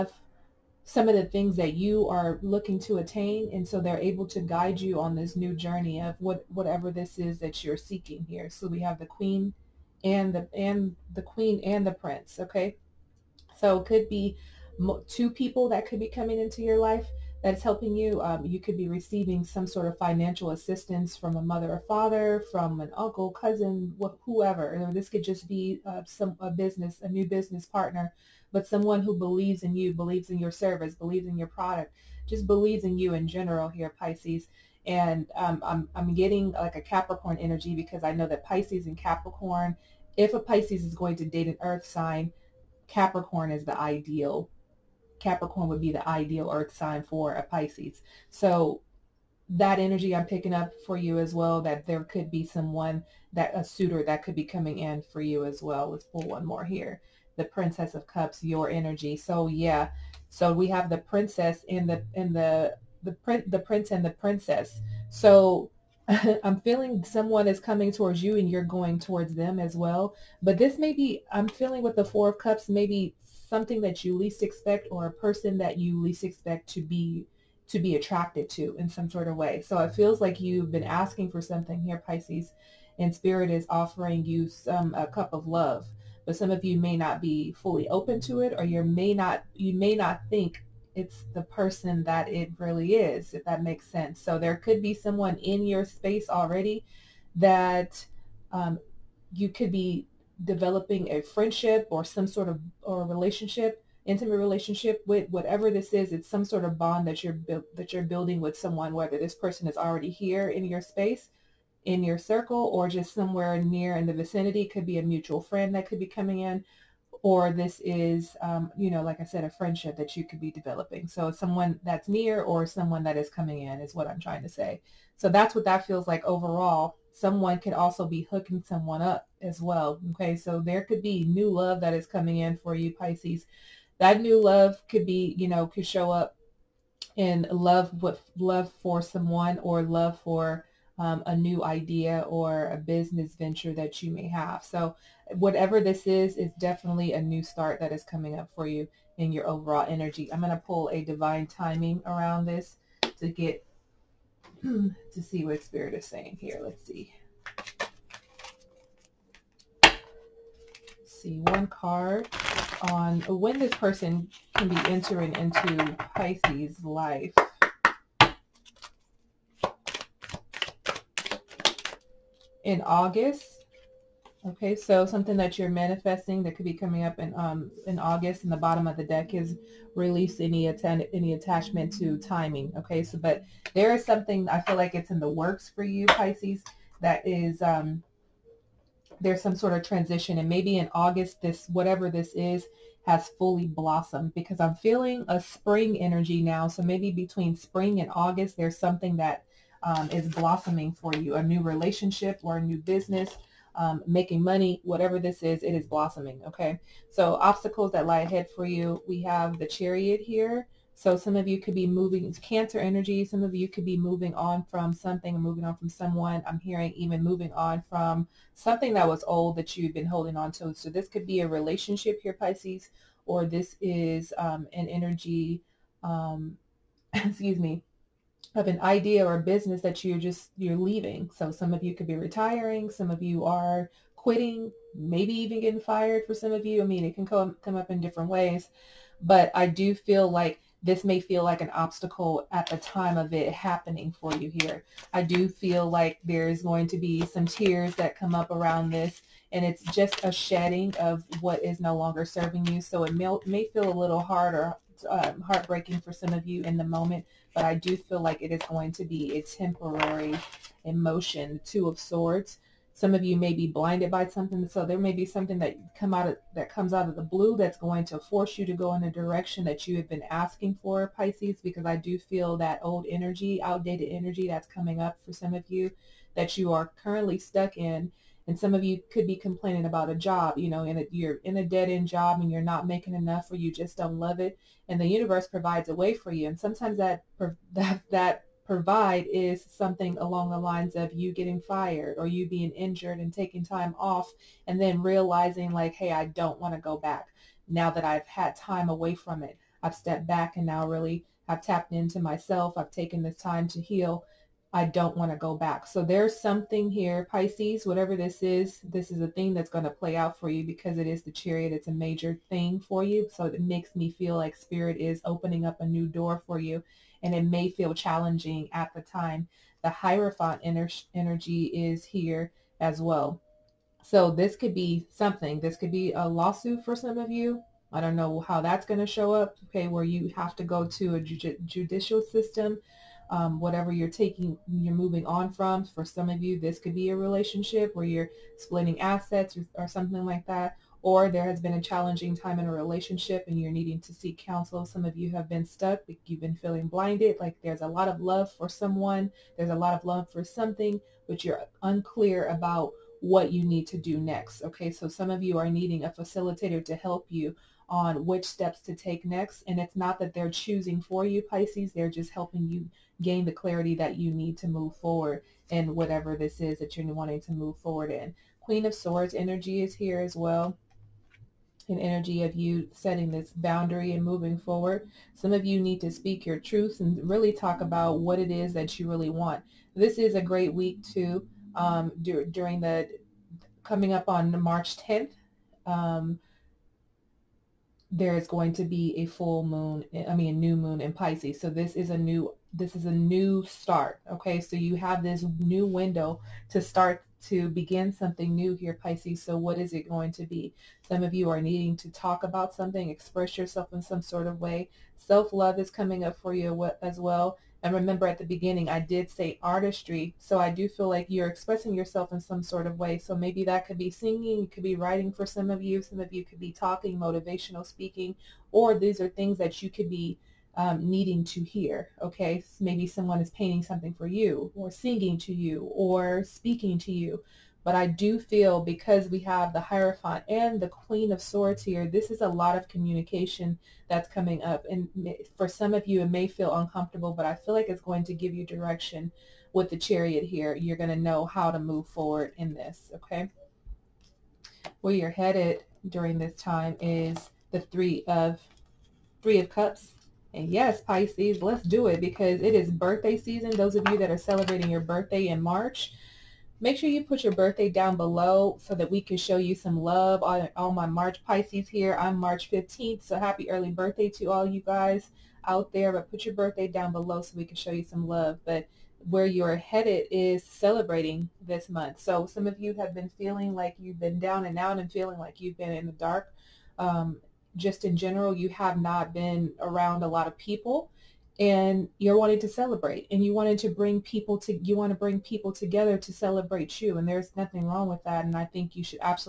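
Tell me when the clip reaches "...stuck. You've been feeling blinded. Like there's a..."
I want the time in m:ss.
5:45.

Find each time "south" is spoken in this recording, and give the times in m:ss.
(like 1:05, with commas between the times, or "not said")
not said.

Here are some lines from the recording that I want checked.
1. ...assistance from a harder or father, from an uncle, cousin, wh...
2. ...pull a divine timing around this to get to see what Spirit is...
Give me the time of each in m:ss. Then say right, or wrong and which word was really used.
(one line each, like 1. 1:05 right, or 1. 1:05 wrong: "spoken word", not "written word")
1. 0:20 wrong: "mother", not "harder"
2. 2:30 right.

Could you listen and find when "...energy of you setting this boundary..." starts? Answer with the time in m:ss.
6:11.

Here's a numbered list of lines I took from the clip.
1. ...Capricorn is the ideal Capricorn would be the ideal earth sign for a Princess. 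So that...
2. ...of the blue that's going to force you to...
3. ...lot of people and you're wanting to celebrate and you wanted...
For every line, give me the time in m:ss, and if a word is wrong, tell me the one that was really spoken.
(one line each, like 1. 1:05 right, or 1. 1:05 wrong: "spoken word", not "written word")
1. 0:42 wrong: "Pisces", not "Princess"
2. 4:27 right
3. 8:00 right.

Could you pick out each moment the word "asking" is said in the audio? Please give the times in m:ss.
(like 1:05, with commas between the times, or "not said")
1:21, 4:30.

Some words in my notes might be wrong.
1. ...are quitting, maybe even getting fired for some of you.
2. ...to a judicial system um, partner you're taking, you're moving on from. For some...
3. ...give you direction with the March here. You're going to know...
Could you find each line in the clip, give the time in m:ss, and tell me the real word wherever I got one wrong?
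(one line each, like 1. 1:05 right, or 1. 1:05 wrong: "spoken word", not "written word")
1. 3:53 right
2. 5:30 wrong: "whatever", not "partner"
3. 7:18 wrong: "Chariot", not "March".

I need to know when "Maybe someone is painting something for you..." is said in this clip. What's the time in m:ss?
7:02.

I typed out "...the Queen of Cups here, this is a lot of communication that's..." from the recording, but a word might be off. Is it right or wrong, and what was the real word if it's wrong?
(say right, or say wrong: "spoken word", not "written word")
wrong: "Swords", not "Cups".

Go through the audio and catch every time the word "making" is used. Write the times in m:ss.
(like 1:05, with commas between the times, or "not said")
3:24, 4:42.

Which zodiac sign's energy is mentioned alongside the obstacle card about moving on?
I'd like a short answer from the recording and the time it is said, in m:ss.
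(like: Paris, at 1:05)
Cancer, at 3:32.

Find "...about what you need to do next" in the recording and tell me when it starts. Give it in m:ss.
5:52.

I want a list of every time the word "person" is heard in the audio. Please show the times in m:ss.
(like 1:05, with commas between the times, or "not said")
1:15, 1:31, 1:49, 2:43.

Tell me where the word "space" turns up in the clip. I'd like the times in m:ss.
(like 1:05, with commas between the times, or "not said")
1:35, 1:50.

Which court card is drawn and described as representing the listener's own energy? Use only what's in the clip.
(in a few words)
Princess of Cups.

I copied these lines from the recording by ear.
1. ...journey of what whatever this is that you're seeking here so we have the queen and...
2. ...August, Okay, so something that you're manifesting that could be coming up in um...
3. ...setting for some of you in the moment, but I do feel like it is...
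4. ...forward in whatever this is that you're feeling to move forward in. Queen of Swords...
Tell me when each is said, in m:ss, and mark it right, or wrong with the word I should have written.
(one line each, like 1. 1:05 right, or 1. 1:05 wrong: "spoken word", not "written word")
1. 0:05 right
2. 2:52 right
3. 4:15 wrong: "heartbreaking", not "setting"
4. 6:04 wrong: "wanting", not "feeling".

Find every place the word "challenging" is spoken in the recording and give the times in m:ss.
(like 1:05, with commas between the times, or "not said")
5:17, 5:41.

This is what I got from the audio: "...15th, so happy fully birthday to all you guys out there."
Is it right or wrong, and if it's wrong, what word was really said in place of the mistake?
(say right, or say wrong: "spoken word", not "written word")
wrong: "early", not "fully".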